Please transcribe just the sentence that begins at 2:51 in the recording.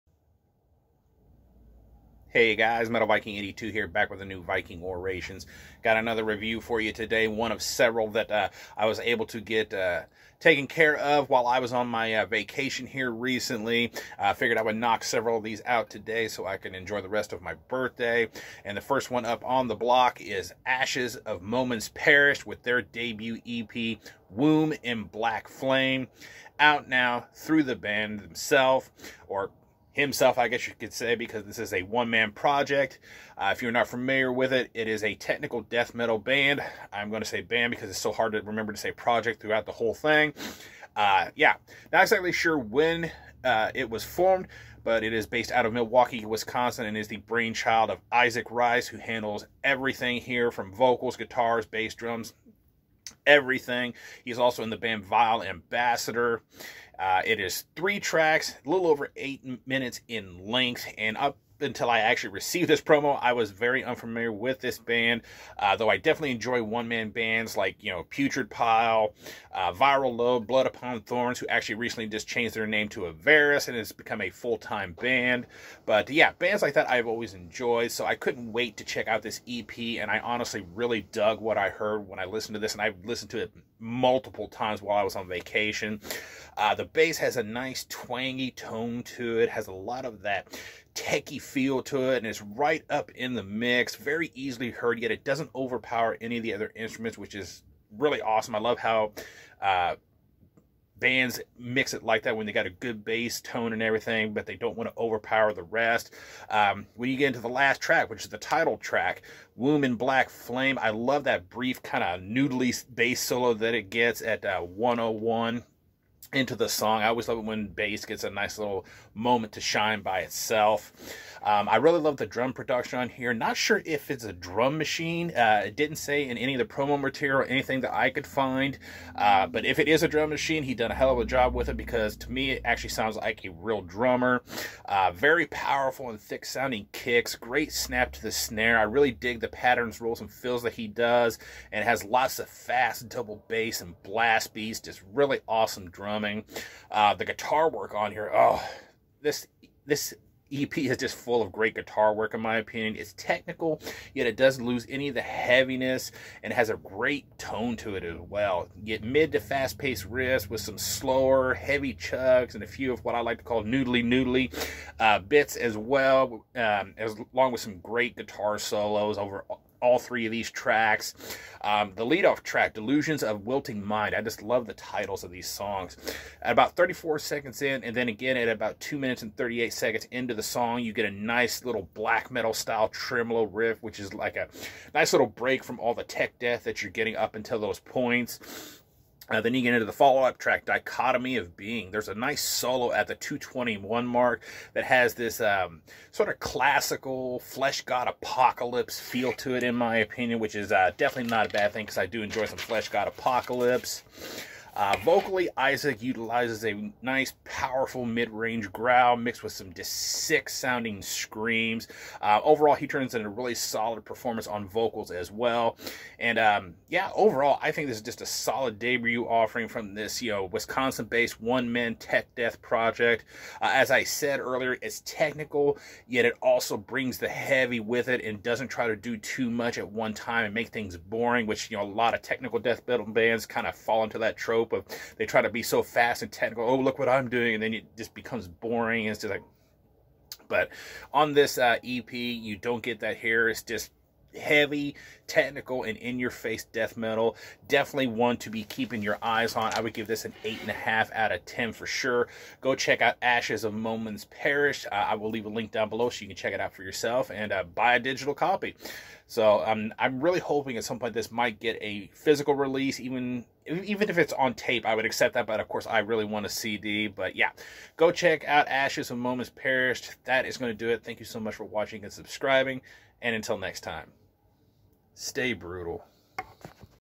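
Um, the leadoff track, Delusions of Wilting Mind.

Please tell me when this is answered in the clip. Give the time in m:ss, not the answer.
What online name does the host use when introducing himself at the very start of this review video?
0:02.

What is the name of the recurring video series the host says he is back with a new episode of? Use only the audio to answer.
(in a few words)
Viking Orations.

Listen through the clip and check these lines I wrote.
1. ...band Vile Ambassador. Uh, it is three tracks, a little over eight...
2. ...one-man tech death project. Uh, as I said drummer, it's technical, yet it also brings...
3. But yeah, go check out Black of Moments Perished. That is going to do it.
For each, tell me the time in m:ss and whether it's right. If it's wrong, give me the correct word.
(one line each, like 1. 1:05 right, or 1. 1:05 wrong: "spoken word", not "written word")
1. 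0:54 right
2. 3:41 wrong: "earlier", not "drummer"
3. 4:27 wrong: "Ashes", not "Black".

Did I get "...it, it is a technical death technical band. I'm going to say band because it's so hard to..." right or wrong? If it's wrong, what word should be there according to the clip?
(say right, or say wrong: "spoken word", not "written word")
wrong: "metal", not "technical".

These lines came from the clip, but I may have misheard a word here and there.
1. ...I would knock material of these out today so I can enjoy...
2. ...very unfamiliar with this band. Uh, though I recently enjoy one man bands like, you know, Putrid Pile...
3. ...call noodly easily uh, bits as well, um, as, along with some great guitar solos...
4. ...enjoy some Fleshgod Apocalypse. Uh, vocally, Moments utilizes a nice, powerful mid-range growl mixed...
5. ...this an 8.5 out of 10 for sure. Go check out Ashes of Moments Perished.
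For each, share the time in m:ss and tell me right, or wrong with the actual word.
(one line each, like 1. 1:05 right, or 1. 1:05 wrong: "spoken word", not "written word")
1. 0:14 wrong: "several", not "material"
2. 1:03 wrong: "definitely", not "recently"
3. 2:43 wrong: "noodly", not "easily"
4. 3:22 wrong: "Isaac", not "Moments"
5. 4:10 right.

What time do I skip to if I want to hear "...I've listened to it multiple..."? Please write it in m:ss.
1:22.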